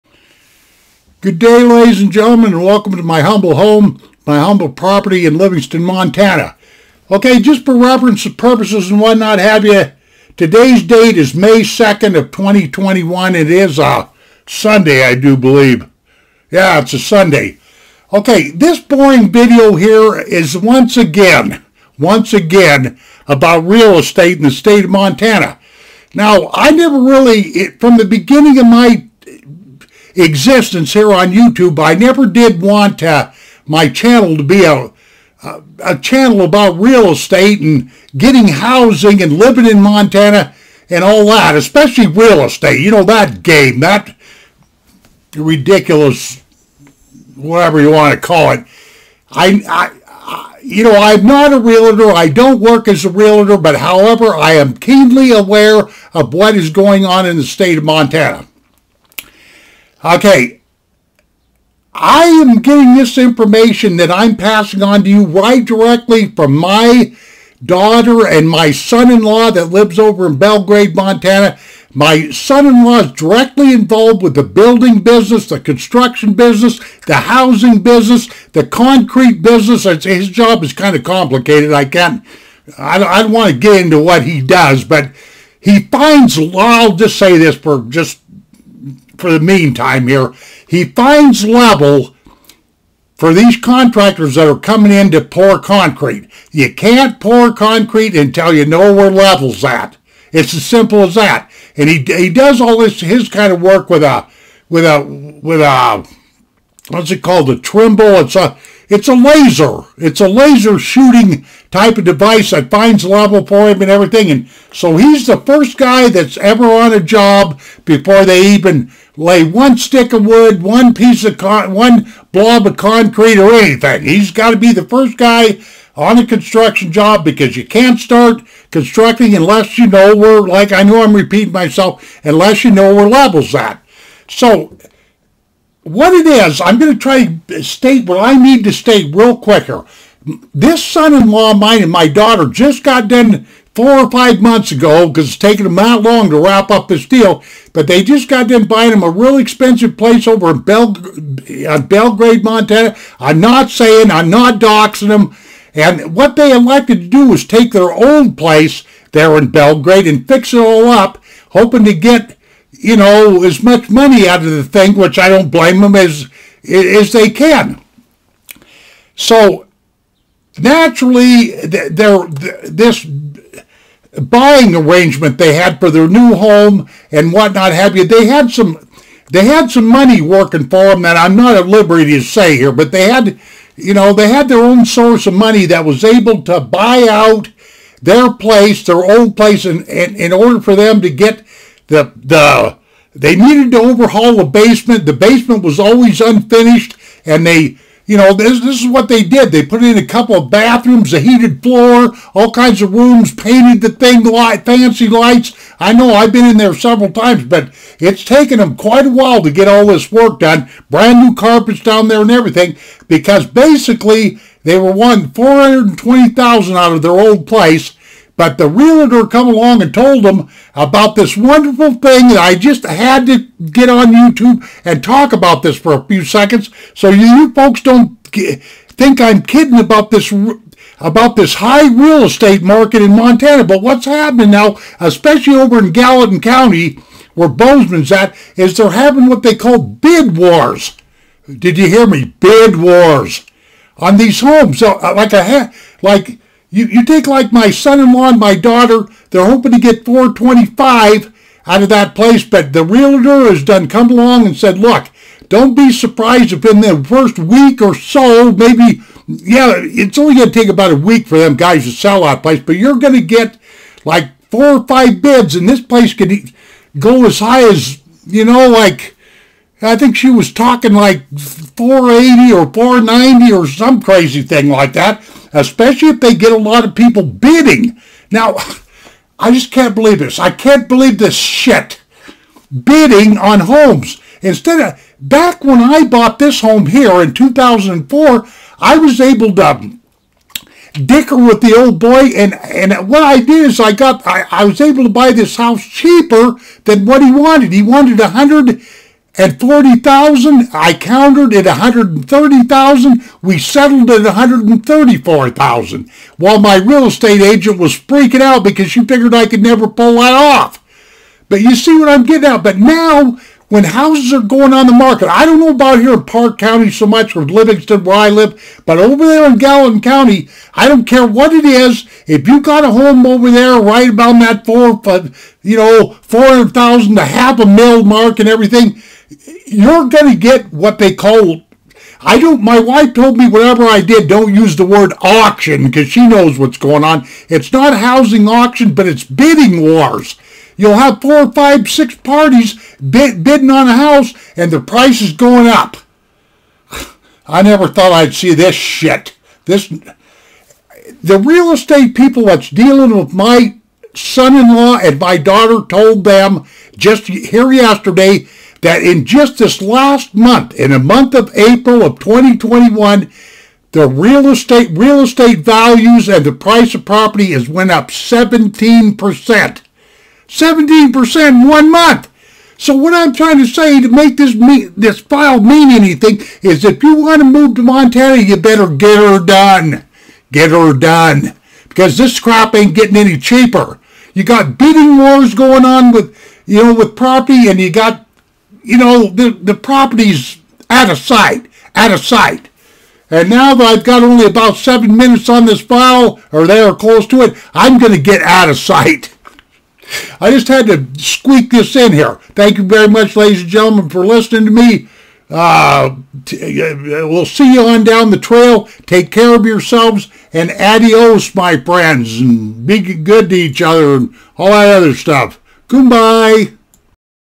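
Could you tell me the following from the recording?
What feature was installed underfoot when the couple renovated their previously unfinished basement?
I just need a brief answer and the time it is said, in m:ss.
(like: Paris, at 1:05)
A heated floor, at 3:21.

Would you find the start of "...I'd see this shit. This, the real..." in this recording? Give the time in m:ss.
5:48.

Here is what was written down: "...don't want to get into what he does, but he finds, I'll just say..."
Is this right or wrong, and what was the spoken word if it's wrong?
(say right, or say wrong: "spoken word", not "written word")
right.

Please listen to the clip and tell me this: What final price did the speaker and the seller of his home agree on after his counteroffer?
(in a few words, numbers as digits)
$134,000.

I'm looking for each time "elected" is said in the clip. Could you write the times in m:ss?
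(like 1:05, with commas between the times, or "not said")
2:36.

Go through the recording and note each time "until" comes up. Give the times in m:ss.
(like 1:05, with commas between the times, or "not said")
1:38.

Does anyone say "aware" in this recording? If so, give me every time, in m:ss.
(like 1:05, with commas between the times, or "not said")
0:55.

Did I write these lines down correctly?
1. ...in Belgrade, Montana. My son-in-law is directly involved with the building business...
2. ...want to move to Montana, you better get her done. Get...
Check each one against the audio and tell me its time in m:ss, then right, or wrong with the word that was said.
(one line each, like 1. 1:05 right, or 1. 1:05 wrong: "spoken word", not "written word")
1. 1:10 right
2. 6:17 right.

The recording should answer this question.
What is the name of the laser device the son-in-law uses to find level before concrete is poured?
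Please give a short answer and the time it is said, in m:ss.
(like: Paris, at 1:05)
Trimble, at 1:47.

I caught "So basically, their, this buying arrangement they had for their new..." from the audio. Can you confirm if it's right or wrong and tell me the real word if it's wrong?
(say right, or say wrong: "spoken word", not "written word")
wrong: "naturally", not "basically".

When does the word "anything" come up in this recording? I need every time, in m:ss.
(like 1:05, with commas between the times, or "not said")
2:03, 6:15.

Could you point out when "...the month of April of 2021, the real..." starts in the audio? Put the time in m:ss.
6:00.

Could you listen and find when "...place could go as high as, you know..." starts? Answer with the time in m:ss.
4:25.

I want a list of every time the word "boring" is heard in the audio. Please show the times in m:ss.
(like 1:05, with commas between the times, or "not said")
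0:18.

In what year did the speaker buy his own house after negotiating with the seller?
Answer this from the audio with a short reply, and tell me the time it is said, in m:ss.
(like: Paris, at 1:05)
2004, at 4:47.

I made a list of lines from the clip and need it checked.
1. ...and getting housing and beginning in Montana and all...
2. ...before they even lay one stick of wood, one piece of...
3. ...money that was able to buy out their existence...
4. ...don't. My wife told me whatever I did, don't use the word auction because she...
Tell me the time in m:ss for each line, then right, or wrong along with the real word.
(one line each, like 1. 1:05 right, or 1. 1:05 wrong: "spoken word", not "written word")
1. 0:37 wrong: "living", not "beginning"
2. 1:57 right
3. 3:05 wrong: "place", not "existence"
4. 5:32 right.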